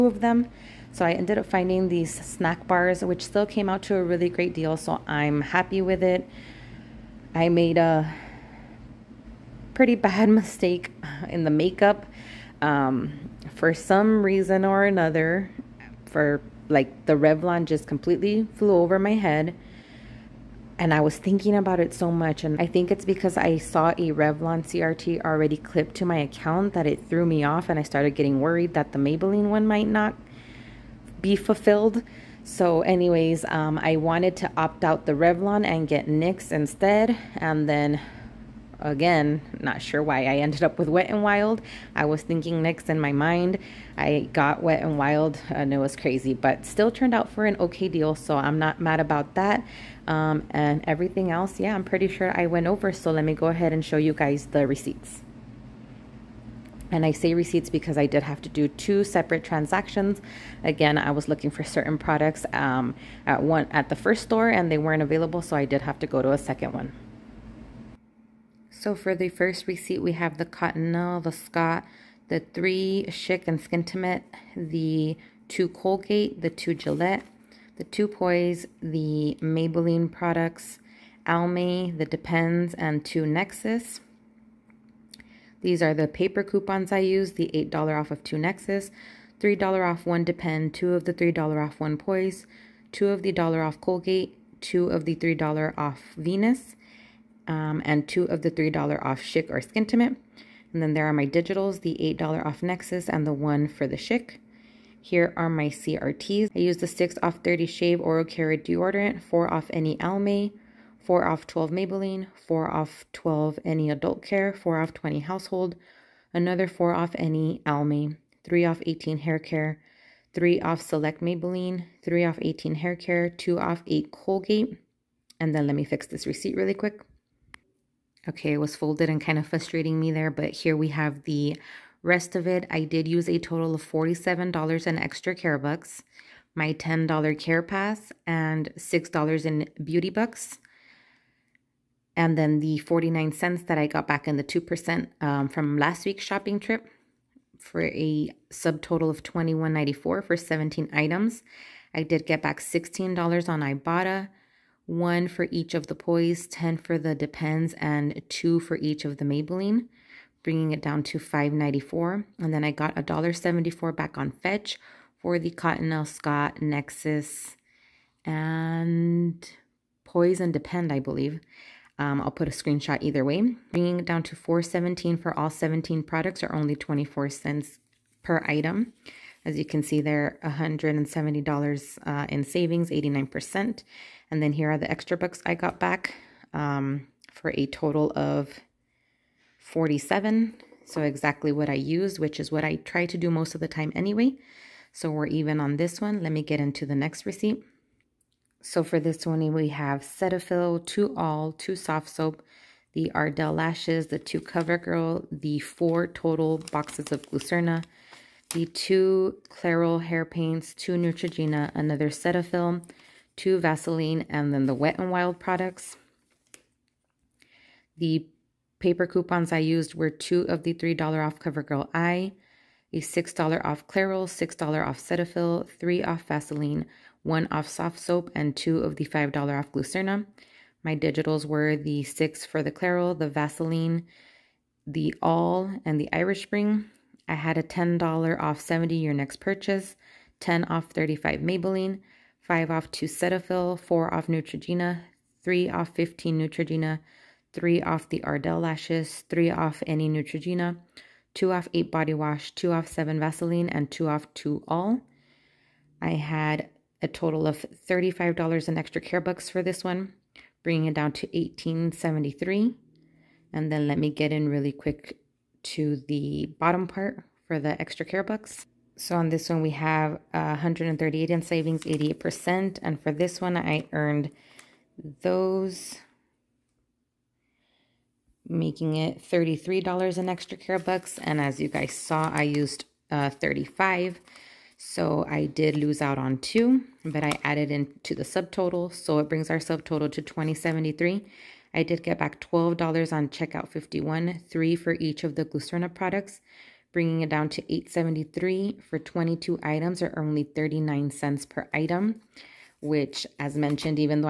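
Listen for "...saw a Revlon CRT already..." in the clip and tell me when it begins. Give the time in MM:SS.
00:23.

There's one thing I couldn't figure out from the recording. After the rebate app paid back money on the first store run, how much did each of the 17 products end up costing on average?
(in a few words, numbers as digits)
24 cents.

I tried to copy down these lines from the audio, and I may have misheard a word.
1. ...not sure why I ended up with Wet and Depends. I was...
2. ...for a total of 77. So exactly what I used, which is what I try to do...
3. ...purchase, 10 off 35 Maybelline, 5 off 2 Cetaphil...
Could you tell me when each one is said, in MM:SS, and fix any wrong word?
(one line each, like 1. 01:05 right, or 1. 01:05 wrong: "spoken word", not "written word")
1. 00:39 wrong: "Wild", not "Depends"
2. 03:07 wrong: "47", not "77"
3. 03:59 right.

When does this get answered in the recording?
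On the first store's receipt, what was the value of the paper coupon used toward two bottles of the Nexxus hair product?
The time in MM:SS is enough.
01:27.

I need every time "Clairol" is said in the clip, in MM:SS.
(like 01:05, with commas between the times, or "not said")
03:29, 03:43, 03:52.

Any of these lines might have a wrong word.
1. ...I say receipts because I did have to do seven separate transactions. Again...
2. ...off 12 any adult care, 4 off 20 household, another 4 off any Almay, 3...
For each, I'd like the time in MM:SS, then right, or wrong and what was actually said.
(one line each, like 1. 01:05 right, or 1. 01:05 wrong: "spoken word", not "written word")
1. 00:57 wrong: "two", not "seven"
2. 01:52 right.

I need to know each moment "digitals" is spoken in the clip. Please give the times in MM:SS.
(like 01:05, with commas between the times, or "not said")
01:41, 03:50.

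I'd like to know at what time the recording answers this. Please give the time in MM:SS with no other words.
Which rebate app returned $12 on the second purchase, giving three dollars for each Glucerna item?
04:53.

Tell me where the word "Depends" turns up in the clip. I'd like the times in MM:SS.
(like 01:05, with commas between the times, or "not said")
01:22, 01:30, 02:37, 02:50.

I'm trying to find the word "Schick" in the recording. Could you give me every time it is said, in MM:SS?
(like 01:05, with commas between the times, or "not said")
01:13, 01:39, 01:43.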